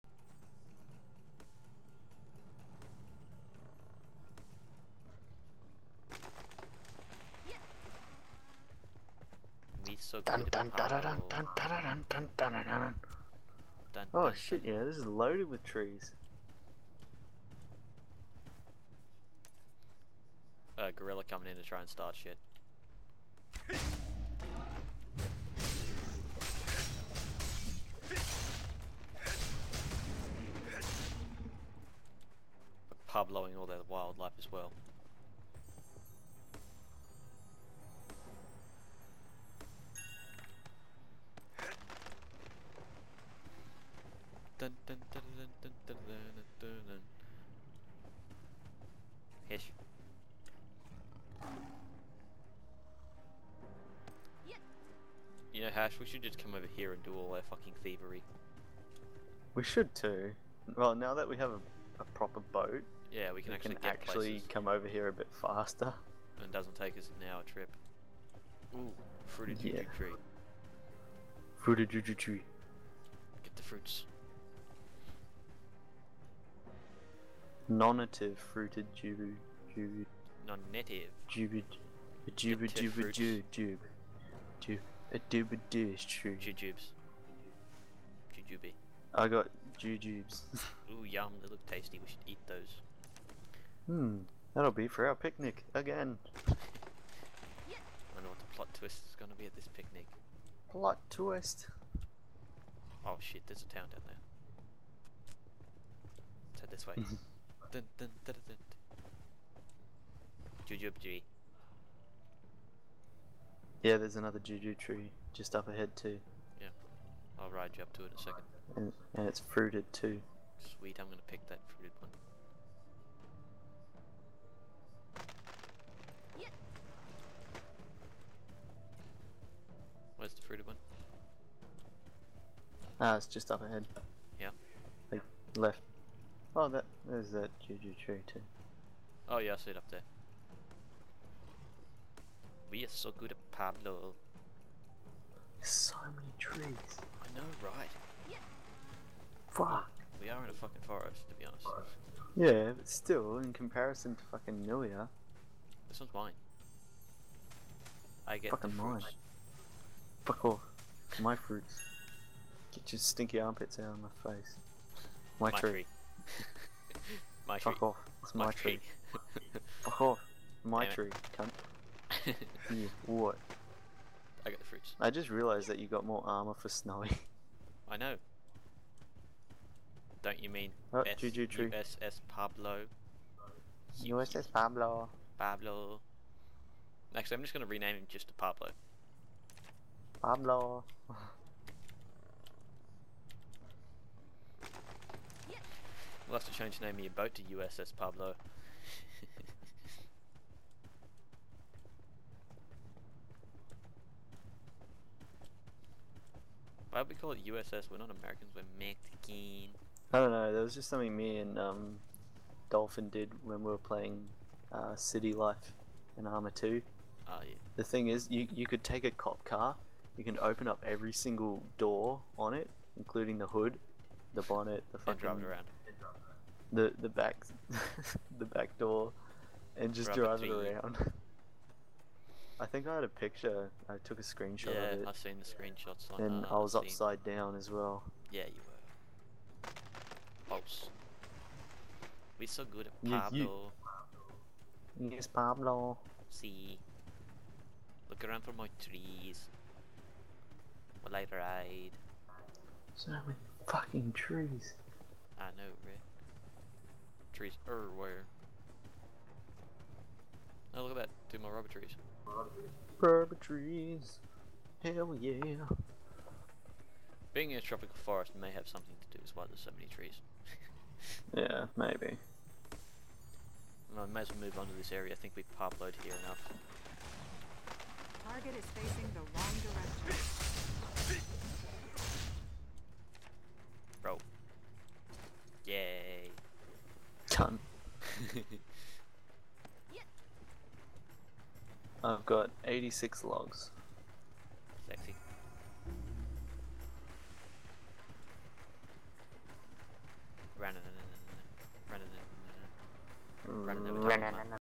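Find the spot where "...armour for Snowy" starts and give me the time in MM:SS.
02:56.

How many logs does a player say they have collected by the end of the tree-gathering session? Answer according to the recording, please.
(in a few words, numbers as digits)
86.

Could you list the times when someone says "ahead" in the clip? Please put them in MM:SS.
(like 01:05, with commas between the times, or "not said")
01:55, 02:13.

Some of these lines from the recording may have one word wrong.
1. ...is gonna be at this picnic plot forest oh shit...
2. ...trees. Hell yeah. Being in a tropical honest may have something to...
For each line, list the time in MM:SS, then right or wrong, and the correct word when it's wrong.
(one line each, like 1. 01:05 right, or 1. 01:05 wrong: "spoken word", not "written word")
1. 01:39 wrong: "twist", not "forest"
2. 04:23 wrong: "forest", not "honest".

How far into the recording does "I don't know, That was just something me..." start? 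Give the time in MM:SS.
03:30.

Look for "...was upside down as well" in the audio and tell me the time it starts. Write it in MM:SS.
03:56.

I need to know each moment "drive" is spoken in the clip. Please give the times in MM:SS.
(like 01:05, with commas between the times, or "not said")
03:45, 03:50.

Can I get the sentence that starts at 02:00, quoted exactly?
Sweet, I'm gonna pick that fruited one.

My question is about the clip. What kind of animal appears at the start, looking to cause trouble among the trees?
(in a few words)
Gorilla.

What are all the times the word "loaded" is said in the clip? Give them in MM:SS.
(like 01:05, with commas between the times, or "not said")
00:15, 04:35.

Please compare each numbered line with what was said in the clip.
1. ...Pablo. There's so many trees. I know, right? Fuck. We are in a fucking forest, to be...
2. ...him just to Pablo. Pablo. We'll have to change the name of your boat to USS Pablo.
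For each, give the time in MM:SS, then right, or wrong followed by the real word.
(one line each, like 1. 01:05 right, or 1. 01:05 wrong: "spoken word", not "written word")
1. 02:23 right
2. 03:07 right.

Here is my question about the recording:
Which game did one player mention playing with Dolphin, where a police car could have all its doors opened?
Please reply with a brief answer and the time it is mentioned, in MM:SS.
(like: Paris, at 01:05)
City Life and Armor 2, at 03:34.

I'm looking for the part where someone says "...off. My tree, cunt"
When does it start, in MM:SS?
02:50.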